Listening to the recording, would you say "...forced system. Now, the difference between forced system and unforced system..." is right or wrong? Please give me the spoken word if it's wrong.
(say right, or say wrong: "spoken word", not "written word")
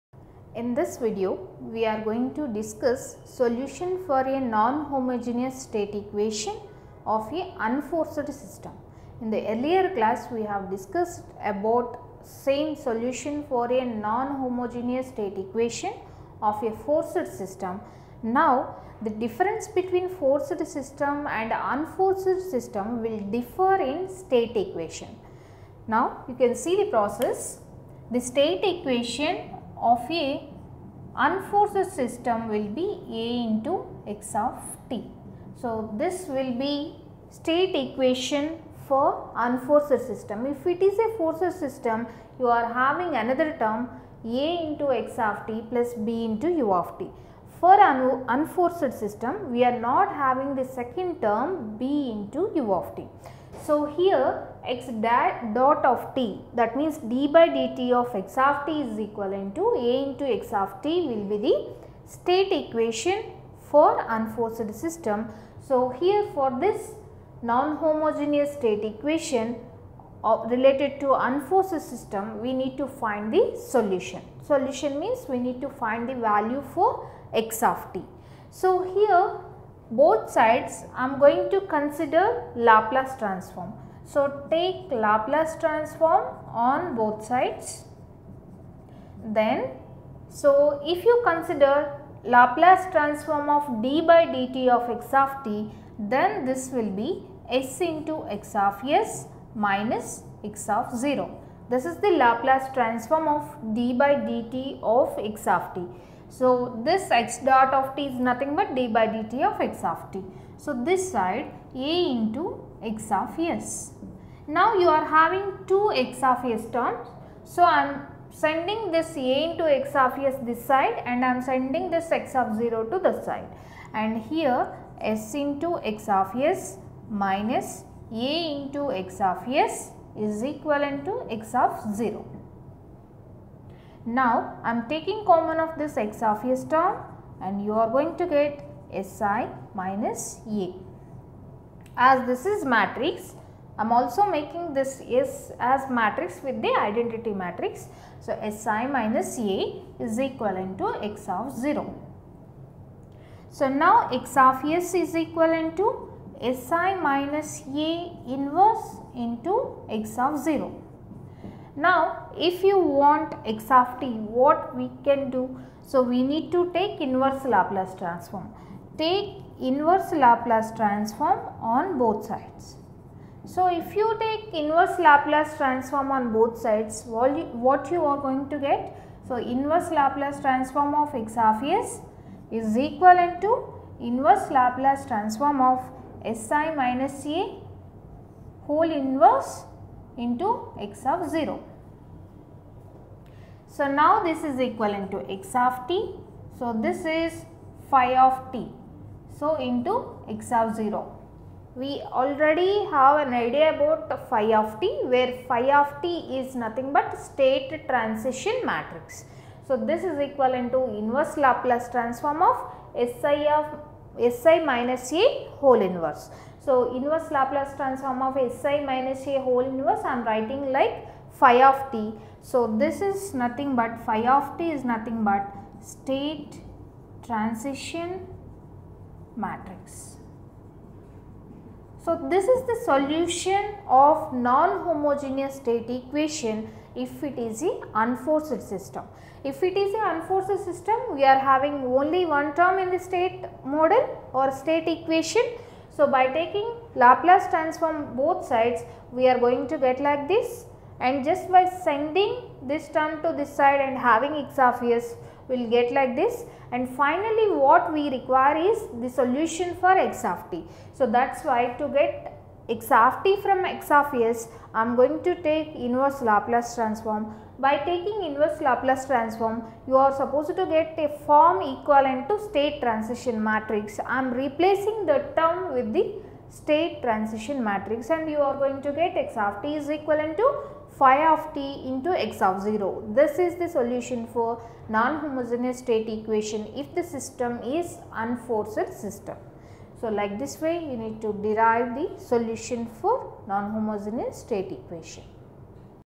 right.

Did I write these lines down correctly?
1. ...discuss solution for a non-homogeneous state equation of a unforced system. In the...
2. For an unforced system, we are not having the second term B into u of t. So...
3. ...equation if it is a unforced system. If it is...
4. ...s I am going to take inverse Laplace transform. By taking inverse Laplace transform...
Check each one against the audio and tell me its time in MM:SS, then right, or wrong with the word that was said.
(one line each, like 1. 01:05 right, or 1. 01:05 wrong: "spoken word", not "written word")
1. 00:02 right
2. 00:47 right
3. 03:55 right
4. 04:24 right.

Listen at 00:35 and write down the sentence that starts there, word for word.
So, this will be state equation for unforced system.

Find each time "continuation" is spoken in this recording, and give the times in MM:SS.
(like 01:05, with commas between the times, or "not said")
not said.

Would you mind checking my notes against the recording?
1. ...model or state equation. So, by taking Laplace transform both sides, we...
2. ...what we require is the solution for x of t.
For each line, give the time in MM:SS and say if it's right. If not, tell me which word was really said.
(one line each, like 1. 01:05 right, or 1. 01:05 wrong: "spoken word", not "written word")
1. 04:03 right
2. 04:17 right.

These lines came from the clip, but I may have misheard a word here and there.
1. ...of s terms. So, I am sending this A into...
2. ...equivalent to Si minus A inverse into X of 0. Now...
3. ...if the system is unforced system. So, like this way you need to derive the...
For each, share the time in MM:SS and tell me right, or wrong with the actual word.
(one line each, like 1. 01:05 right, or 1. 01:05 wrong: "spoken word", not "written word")
1. 01:56 right
2. 02:35 right
3. 04:46 right.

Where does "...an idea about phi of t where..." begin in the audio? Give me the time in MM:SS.
03:23.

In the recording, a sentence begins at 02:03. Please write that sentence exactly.
And here s into x of s minus A into x of s is equivalent to x of 0.